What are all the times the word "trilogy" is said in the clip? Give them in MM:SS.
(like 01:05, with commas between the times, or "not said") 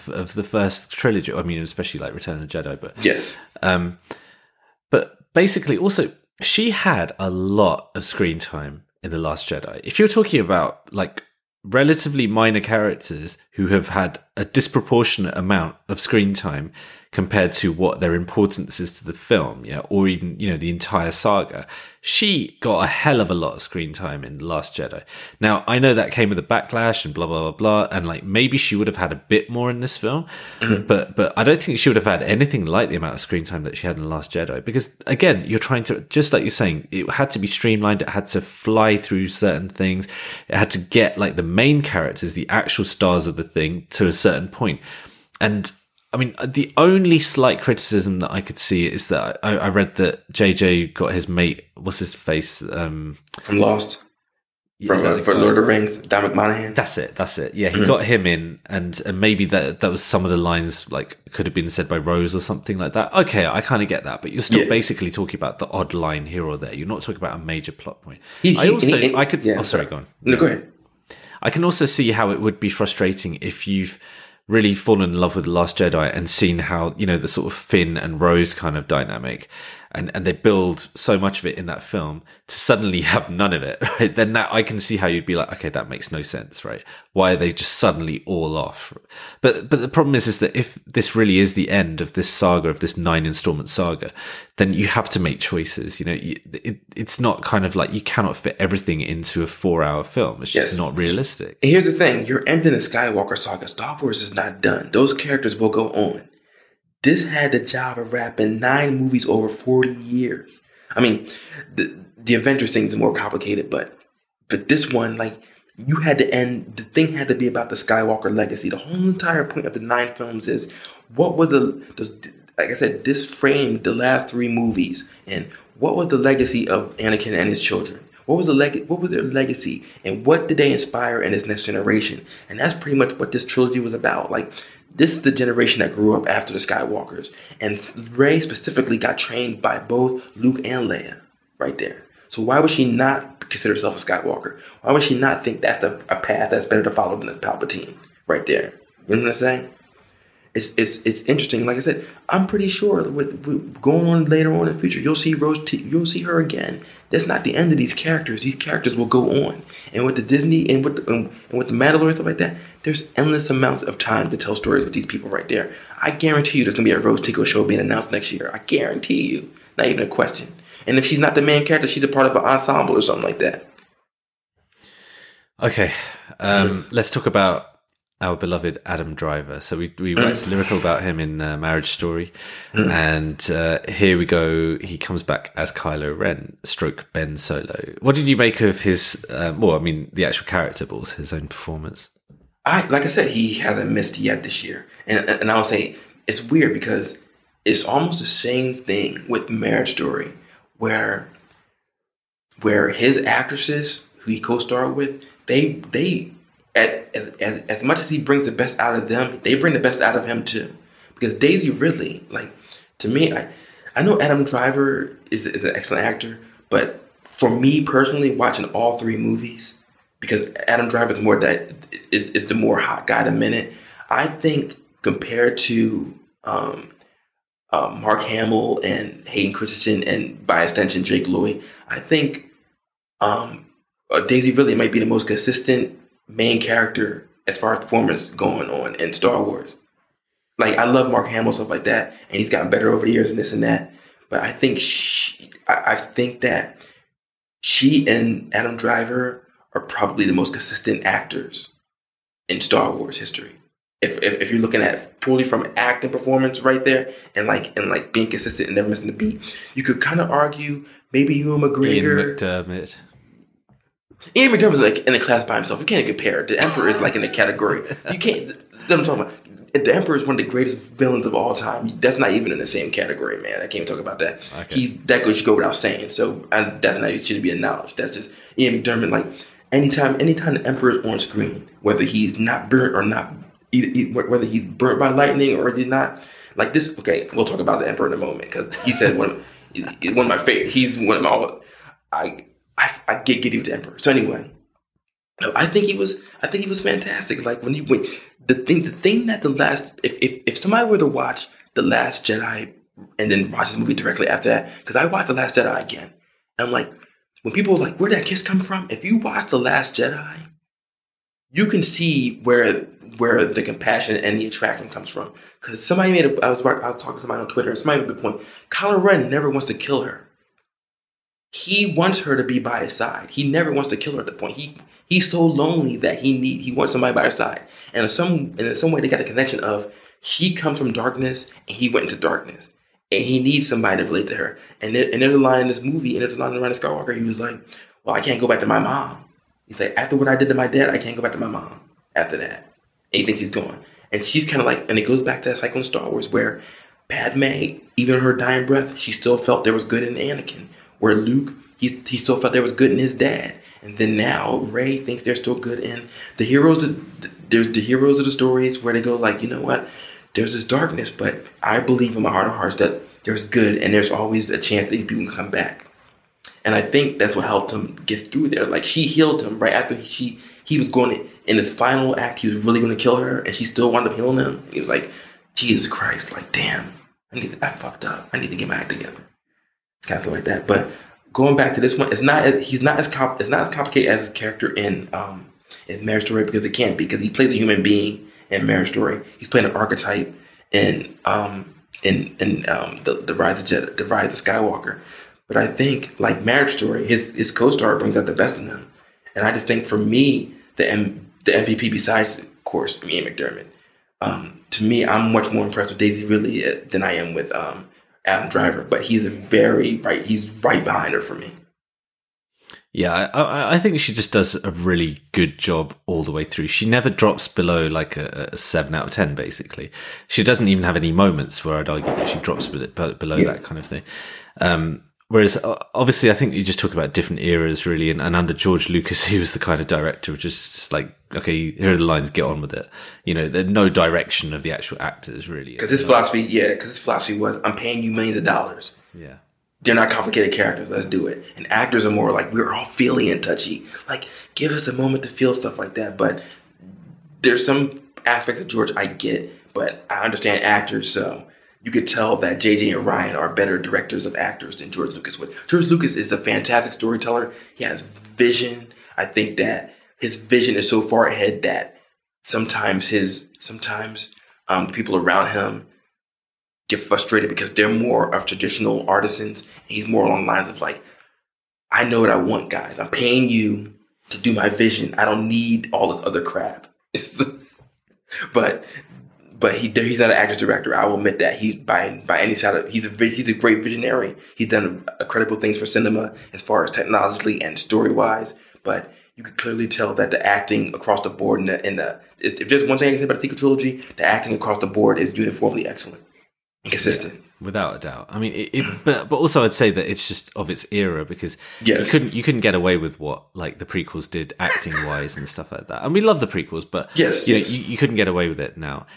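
00:00, 02:13, 08:13.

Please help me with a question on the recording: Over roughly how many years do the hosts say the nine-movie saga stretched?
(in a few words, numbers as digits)
40 years.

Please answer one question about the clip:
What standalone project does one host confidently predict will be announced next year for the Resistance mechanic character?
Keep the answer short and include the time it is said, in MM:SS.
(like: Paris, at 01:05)
Rose Tico show, at 02:46.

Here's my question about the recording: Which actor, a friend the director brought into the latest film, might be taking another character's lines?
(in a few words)
Dan McManahan.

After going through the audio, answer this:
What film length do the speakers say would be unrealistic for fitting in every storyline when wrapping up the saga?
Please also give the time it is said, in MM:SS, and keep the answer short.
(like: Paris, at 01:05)
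4 hours, at 01:39.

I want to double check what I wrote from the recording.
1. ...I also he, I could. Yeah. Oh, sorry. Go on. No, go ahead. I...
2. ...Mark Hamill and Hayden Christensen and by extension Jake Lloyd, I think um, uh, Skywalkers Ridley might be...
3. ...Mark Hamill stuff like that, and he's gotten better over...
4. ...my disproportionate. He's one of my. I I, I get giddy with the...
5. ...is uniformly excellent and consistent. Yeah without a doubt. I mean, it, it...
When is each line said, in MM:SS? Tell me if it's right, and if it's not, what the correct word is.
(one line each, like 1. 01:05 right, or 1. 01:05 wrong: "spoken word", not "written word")
1. 01:08 right
2. 03:48 wrong: "Daisy", not "Skywalkers"
3. 04:01 right
4. 04:50 wrong: "favorite", not "disproportionate"
5. 08:15 right.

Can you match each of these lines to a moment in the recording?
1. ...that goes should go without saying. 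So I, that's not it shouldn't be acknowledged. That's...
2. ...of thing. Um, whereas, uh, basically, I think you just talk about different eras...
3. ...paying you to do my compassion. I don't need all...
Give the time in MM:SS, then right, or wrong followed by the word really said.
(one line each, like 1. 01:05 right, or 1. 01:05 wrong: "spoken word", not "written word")
1. 04:35 right
2. 07:03 wrong: "obviously", not "basically"
3. 07:53 wrong: "vision", not "compassion".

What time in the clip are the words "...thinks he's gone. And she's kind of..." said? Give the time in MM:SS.
05:43.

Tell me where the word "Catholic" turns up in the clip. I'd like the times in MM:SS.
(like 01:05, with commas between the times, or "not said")
06:20.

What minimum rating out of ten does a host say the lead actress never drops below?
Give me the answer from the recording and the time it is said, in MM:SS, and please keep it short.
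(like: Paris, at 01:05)
7, at 06:58.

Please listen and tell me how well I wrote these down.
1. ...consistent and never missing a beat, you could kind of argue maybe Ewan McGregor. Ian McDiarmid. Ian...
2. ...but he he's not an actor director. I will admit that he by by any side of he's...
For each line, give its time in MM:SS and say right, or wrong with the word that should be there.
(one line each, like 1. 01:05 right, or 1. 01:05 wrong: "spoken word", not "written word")
1. 04:18 right
2. 07:59 right.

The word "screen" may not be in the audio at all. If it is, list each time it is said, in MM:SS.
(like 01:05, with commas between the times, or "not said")
00:08, 00:15, 00:23, 00:33, 04:41.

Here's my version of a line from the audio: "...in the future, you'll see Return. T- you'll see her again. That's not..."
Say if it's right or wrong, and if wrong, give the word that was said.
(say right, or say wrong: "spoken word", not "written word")
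wrong: "Rose", not "Return".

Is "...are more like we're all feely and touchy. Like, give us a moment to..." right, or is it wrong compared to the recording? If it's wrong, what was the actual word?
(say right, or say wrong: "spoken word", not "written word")
right.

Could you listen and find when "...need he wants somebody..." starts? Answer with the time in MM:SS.
05:26.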